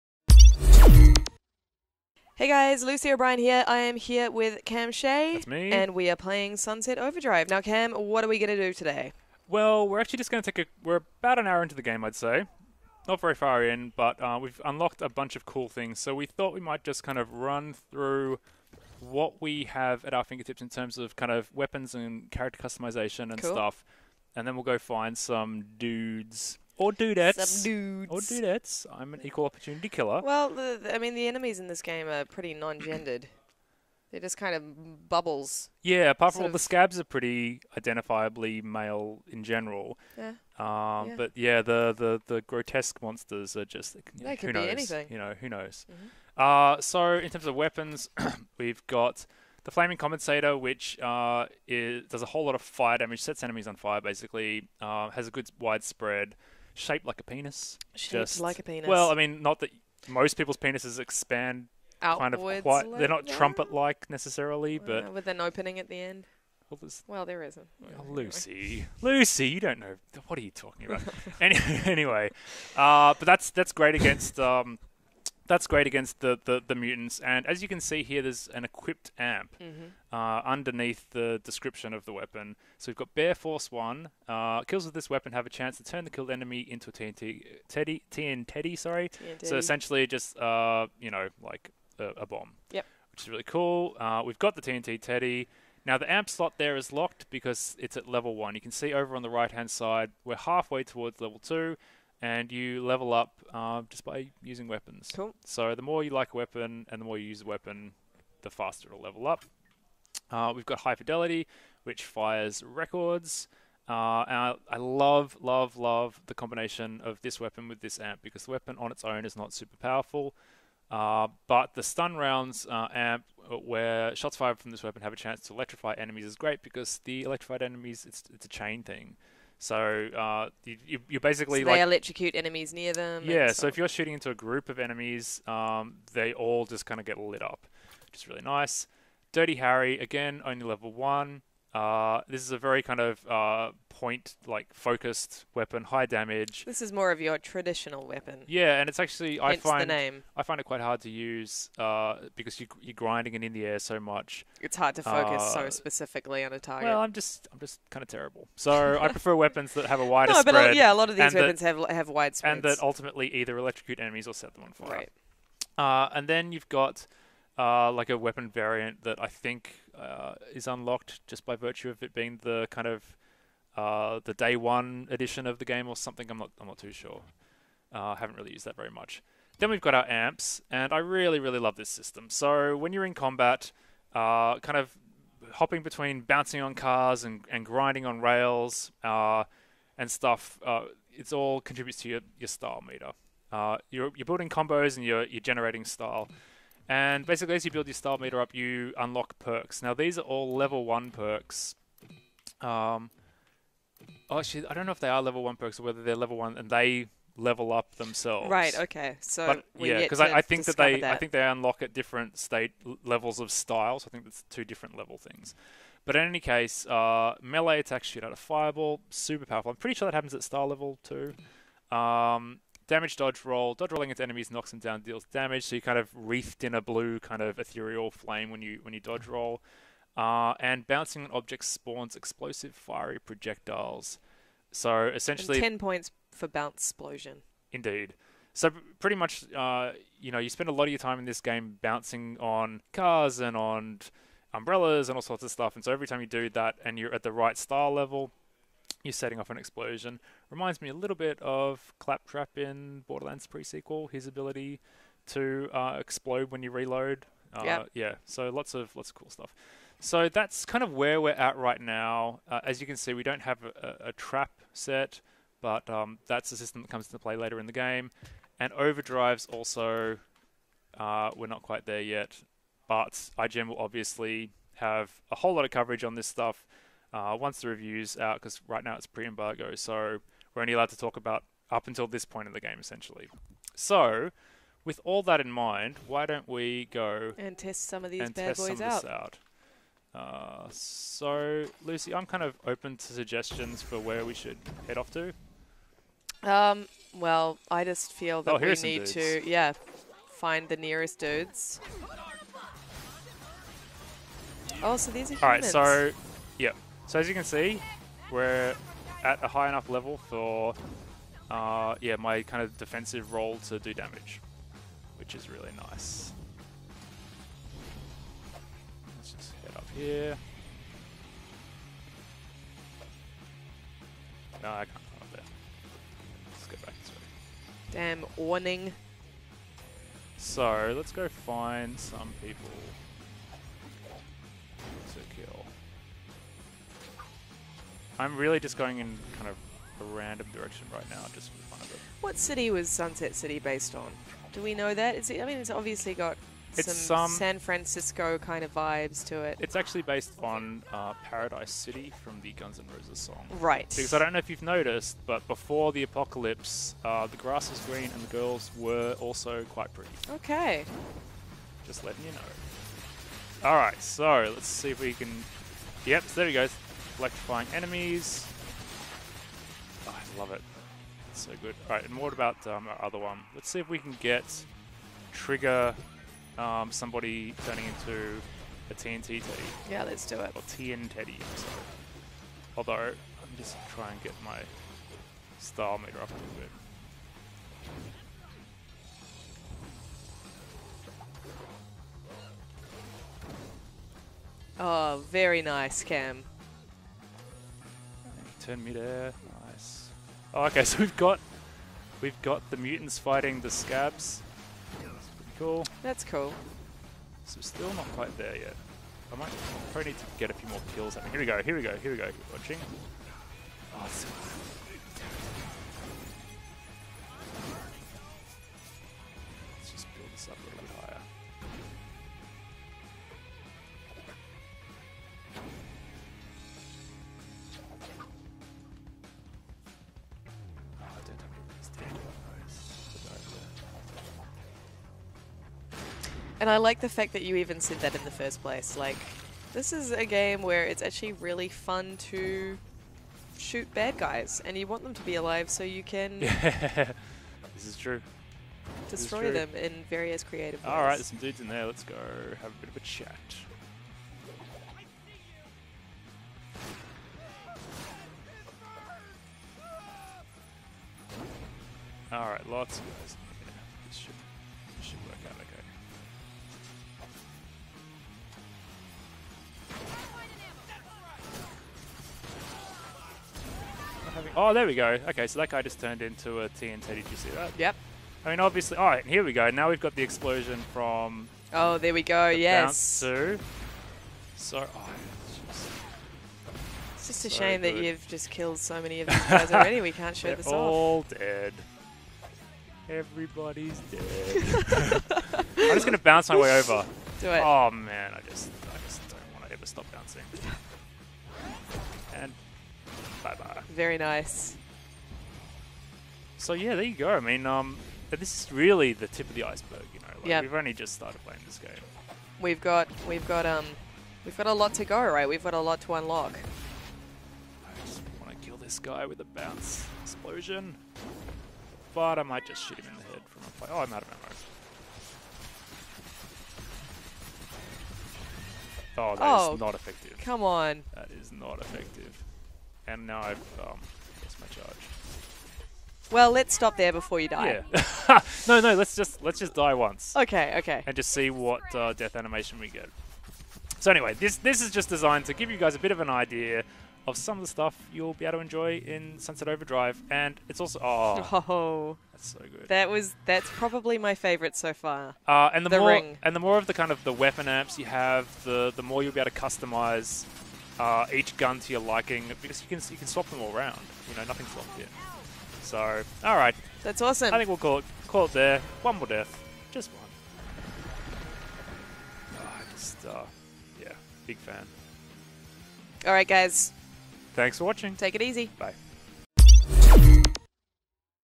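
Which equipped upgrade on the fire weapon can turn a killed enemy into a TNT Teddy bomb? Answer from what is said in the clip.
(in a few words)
Bear Force 1.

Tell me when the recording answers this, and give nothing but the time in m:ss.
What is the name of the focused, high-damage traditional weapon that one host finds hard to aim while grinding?
2:19.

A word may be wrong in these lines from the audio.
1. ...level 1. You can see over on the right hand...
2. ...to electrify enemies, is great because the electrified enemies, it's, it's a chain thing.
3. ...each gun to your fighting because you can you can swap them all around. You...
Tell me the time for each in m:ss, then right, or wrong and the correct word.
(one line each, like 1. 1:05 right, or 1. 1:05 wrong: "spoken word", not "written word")
1. 1:38 right
2. 2:05 right
3. 9:21 wrong: "liking", not "fighting".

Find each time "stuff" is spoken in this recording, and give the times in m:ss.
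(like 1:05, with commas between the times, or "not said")
0:23, 3:10, 4:05, 4:19, 4:36, 9:07.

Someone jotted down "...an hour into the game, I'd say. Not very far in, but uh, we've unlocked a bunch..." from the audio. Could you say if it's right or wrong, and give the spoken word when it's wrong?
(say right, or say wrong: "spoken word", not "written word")
right.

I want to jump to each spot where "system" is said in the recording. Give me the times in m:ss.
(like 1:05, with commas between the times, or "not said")
3:01, 4:26.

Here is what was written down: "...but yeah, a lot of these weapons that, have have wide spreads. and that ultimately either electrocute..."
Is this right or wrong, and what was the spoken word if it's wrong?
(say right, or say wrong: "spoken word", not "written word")
right.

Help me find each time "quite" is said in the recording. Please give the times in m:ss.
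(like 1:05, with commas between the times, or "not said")
1:02, 2:30, 4:31, 5:59, 6:48.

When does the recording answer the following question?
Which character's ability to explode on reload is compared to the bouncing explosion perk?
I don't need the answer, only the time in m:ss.
4:11.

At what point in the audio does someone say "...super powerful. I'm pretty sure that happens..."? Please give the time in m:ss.
3:39.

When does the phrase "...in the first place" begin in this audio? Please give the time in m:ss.
7:18.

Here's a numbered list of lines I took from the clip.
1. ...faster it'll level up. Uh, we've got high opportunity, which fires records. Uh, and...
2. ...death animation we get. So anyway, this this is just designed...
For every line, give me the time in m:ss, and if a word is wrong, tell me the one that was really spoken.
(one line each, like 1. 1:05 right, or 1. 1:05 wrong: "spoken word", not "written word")
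1. 1:48 wrong: "fidelity", not "opportunity"
2. 9:02 right.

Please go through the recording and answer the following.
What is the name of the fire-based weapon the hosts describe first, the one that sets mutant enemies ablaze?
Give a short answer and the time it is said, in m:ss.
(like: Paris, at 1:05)
Flaming Compensator, at 0:49.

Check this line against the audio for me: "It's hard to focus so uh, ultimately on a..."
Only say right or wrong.
wrong.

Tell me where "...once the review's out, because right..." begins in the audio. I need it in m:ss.
4:37.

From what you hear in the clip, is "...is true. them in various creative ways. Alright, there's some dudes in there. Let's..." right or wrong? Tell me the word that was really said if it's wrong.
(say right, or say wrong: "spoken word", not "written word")
right.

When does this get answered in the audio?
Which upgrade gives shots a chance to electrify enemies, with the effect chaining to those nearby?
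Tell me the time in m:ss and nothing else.
2:01.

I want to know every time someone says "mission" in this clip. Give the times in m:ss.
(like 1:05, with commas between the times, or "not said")
not said.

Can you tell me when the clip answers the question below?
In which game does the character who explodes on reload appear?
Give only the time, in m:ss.
4:13.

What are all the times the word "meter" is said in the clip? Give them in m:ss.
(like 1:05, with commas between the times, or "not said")
3:12, 3:18, 6:25.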